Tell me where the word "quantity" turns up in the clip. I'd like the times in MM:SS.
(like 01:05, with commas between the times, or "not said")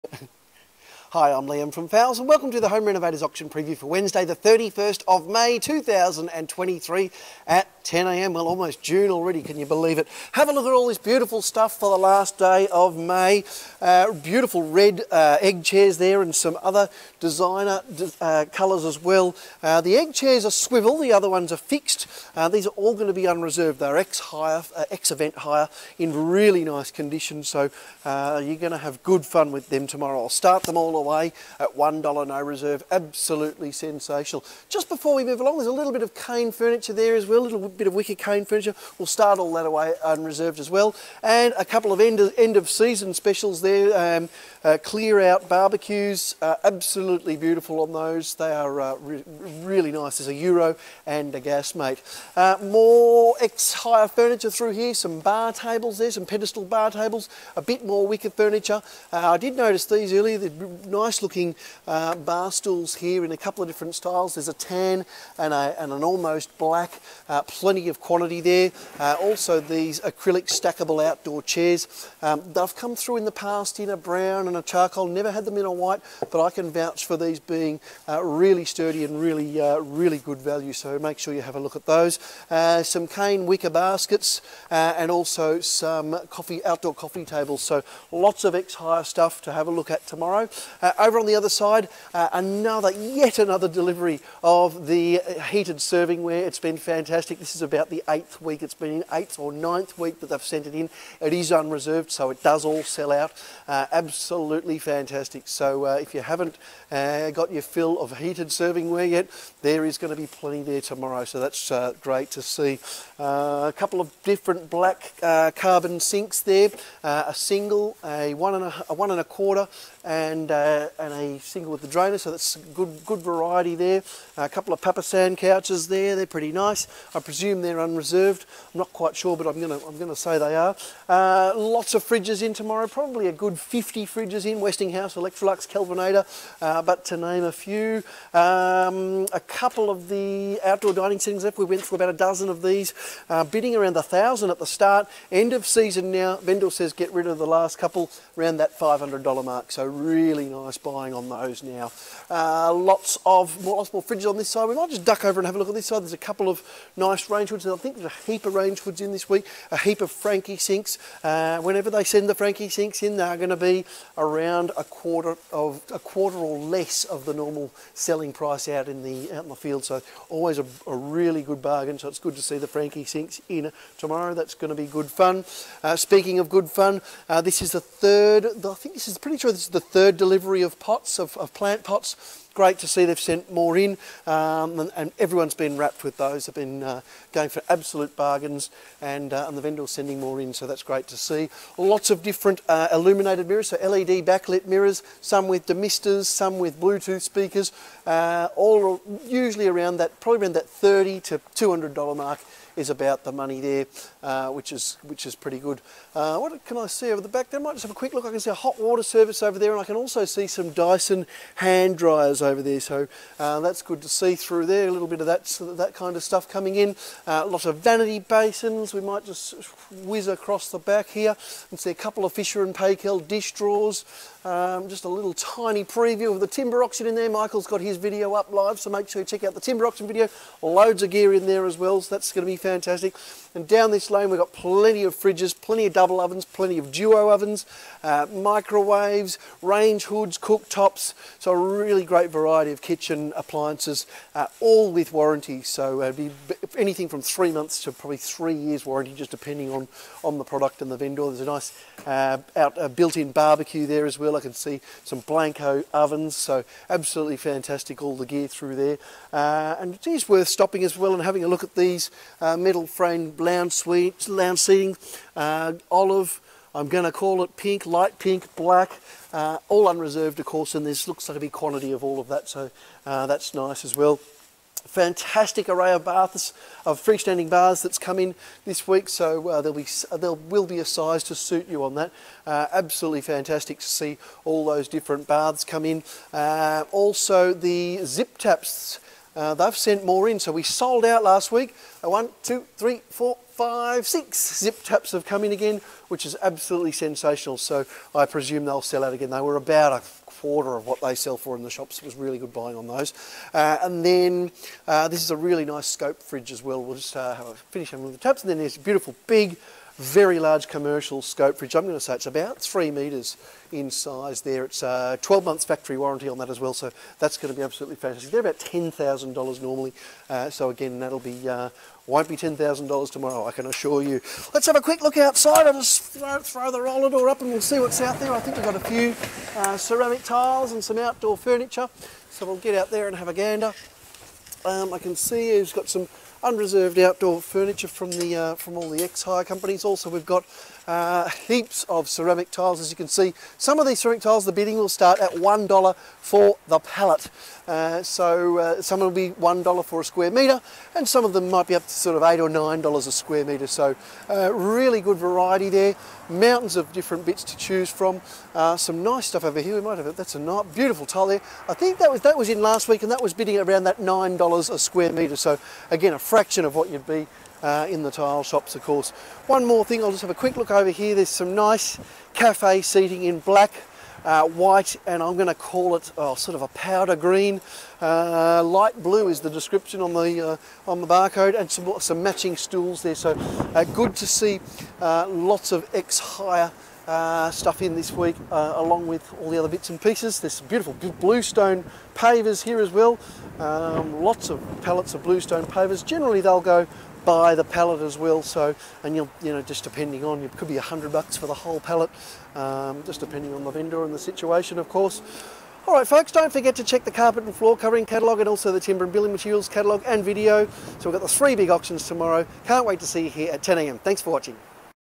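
01:07, 04:31.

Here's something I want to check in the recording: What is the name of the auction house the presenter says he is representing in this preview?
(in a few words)
Fowles.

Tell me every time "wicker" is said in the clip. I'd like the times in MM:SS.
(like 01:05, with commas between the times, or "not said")
00:37, 00:58, 01:23.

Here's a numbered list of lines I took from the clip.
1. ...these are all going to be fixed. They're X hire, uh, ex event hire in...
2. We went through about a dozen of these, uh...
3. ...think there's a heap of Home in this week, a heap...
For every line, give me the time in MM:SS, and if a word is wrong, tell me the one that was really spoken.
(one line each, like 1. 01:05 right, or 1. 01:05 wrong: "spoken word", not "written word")
1. 00:22 wrong: "unreserved", not "fixed"
2. 02:21 right
3. 02:37 wrong: "Rangewoods", not "Home".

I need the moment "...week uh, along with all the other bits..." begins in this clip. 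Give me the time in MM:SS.
06:28.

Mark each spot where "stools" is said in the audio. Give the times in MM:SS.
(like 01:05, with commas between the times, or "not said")
01:02, 06:22.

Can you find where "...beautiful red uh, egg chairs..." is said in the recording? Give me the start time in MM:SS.
00:14.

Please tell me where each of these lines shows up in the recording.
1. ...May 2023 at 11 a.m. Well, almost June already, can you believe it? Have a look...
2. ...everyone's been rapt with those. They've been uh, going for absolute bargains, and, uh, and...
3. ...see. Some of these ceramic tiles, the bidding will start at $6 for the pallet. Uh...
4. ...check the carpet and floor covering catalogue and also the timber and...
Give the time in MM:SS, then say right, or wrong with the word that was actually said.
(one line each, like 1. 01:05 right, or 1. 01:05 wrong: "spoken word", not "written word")
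1. 00:05 wrong: "10", not "11"
2. 03:05 right
3. 05:43 wrong: "1", not "6"
4. 06:46 right.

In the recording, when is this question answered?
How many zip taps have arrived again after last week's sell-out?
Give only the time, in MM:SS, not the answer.
04:54.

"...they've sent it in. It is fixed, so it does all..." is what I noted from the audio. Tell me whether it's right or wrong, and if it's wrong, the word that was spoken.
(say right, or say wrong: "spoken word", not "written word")
wrong: "unreserved", not "fixed".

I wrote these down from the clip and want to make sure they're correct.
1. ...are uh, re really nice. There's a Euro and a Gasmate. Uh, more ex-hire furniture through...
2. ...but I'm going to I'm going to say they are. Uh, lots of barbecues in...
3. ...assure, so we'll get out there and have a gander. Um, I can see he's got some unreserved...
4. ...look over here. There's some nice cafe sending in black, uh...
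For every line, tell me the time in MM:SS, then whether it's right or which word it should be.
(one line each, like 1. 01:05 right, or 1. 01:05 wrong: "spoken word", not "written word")
1. 00:48 right
2. 02:09 wrong: "fridges", not "barbecues"
3. 05:31 wrong: "furniture", not "assure"
4. 06:10 wrong: "seating", not "sending".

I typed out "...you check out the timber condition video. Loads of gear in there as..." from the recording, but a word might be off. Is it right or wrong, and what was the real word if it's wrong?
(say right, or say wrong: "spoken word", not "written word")
wrong: "auction", not "condition".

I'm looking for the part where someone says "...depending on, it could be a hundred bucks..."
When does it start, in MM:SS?
06:39.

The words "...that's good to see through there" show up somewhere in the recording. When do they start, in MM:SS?
03:33.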